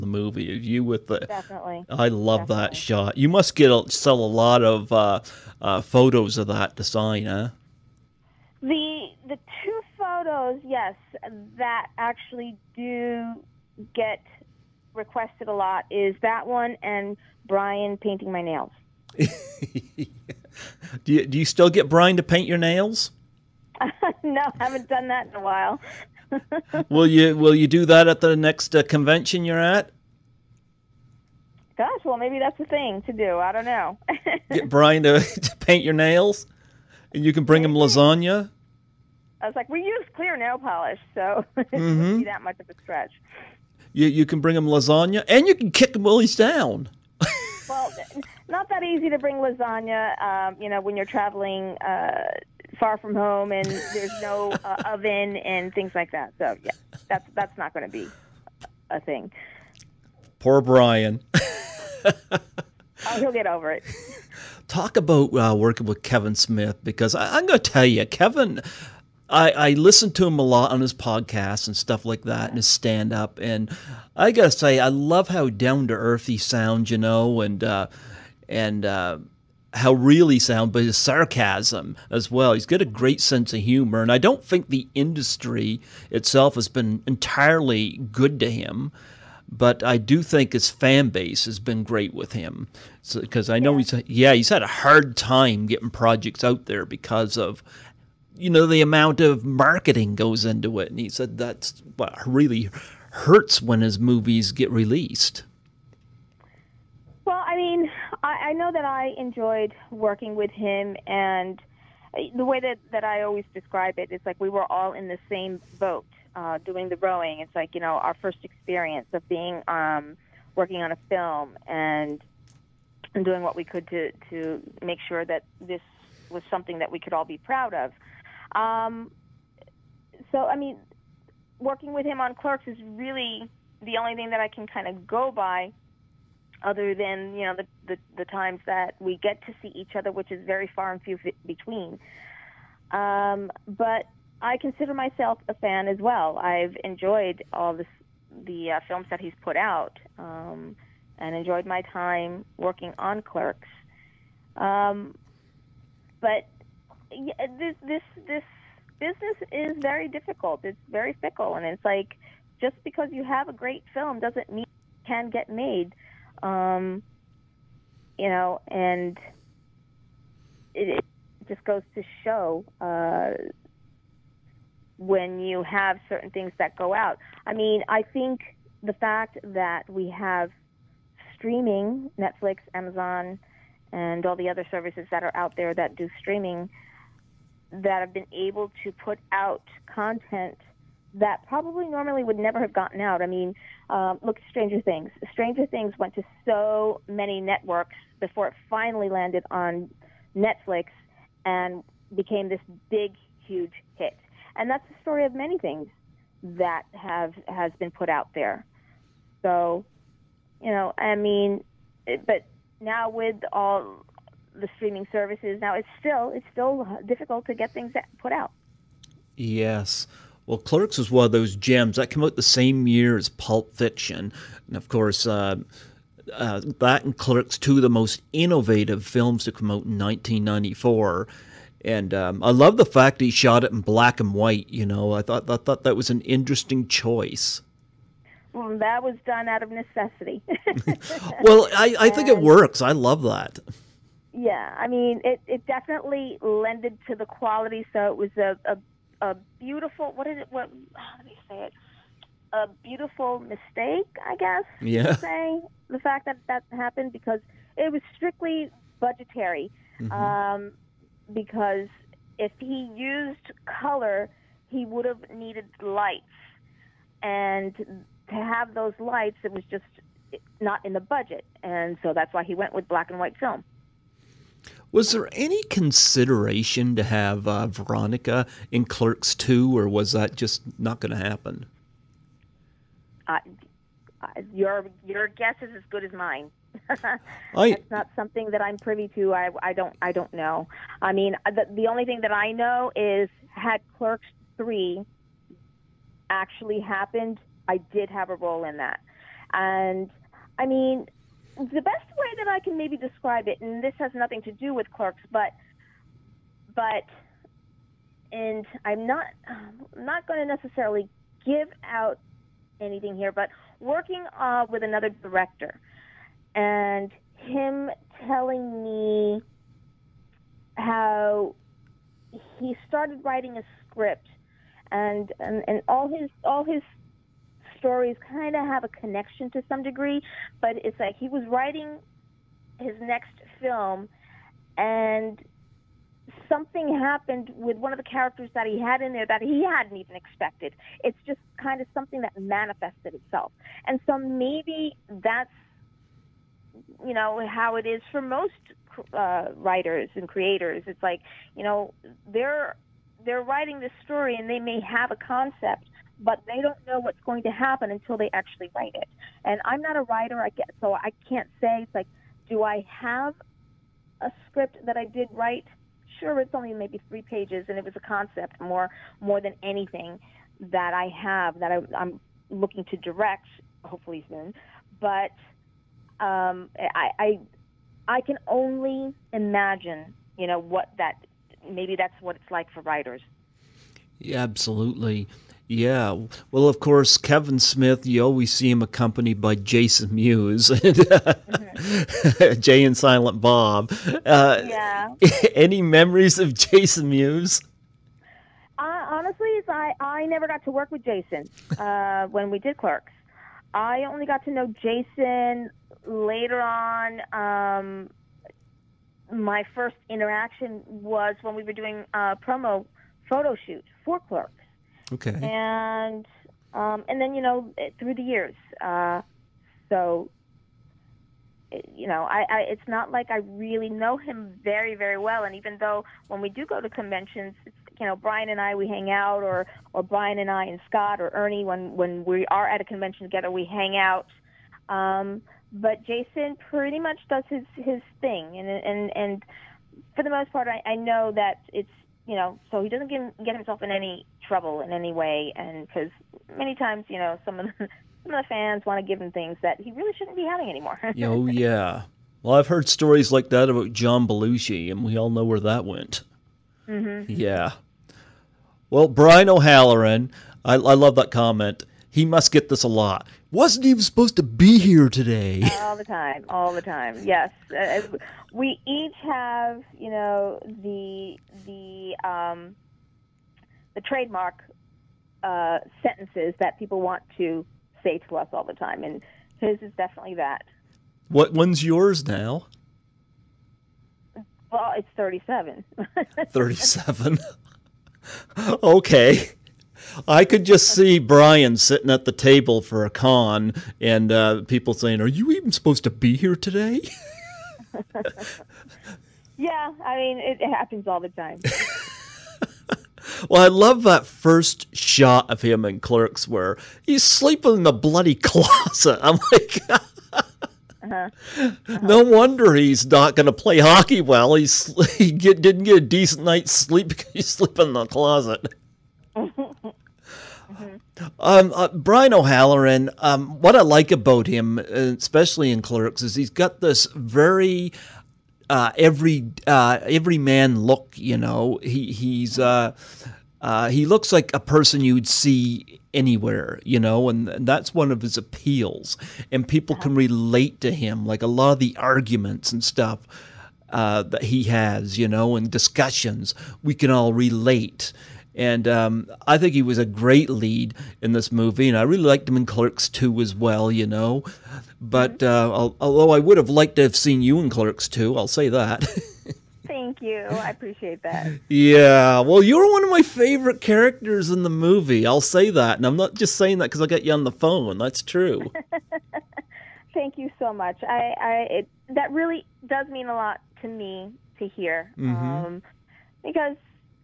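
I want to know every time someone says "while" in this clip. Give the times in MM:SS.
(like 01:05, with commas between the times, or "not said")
00:25, 00:46.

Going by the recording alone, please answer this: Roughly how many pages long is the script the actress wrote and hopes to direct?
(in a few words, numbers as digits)
3.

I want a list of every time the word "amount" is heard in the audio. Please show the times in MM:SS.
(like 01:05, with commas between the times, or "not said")
01:38.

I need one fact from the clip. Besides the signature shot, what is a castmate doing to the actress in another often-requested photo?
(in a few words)
Painting my nails.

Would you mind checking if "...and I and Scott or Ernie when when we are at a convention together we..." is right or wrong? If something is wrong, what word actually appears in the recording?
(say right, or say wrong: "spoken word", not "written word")
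right.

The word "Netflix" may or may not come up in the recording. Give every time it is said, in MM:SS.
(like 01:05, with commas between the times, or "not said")
03:02, 03:20.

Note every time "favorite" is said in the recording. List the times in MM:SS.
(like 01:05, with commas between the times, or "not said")
09:23.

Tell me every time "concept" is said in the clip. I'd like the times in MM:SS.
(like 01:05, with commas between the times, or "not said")
05:55, 06:07.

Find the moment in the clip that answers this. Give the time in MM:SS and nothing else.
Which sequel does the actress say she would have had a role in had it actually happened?
04:53.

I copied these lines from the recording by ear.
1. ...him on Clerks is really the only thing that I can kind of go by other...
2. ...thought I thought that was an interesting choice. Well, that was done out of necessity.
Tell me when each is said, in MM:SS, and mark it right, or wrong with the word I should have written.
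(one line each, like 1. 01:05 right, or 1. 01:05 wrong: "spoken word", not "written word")
1. 02:12 right
2. 03:55 right.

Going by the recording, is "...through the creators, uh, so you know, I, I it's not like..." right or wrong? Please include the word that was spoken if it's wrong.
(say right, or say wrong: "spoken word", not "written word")
wrong: "years", not "creators".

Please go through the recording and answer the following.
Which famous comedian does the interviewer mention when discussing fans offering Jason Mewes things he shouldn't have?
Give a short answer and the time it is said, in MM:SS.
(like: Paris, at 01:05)
John Belushi, at 07:33.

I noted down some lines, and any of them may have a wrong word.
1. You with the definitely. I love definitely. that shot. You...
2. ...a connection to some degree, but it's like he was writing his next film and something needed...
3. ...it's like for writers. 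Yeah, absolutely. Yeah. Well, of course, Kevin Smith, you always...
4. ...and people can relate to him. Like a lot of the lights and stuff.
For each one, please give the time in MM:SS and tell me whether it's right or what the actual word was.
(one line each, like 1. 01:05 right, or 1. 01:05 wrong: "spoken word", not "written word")
1. 00:00 right
2. 05:28 wrong: "happened", not "needed"
3. 06:22 right
4. 08:59 wrong: "arguments", not "lights".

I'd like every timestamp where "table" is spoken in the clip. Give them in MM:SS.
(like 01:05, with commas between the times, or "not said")
08:12.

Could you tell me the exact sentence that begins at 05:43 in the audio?
And so maybe that's you know how it is for most uh, writers and creators.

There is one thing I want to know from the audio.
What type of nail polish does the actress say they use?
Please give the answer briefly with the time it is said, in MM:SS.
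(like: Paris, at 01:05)
Clear, at 00:40.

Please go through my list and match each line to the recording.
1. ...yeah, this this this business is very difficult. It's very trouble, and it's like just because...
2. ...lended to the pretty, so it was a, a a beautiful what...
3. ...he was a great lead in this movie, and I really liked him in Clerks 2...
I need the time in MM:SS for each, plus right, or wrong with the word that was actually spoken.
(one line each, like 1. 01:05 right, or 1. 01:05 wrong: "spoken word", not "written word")
1. 02:37 wrong: "fickle", not "trouble"
2. 04:06 wrong: "quality", not "pretty"
3. 09:09 right.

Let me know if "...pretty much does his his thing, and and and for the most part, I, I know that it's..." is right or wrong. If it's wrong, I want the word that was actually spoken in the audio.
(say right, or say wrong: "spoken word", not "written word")
right.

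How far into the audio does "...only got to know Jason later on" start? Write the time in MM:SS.
06:44.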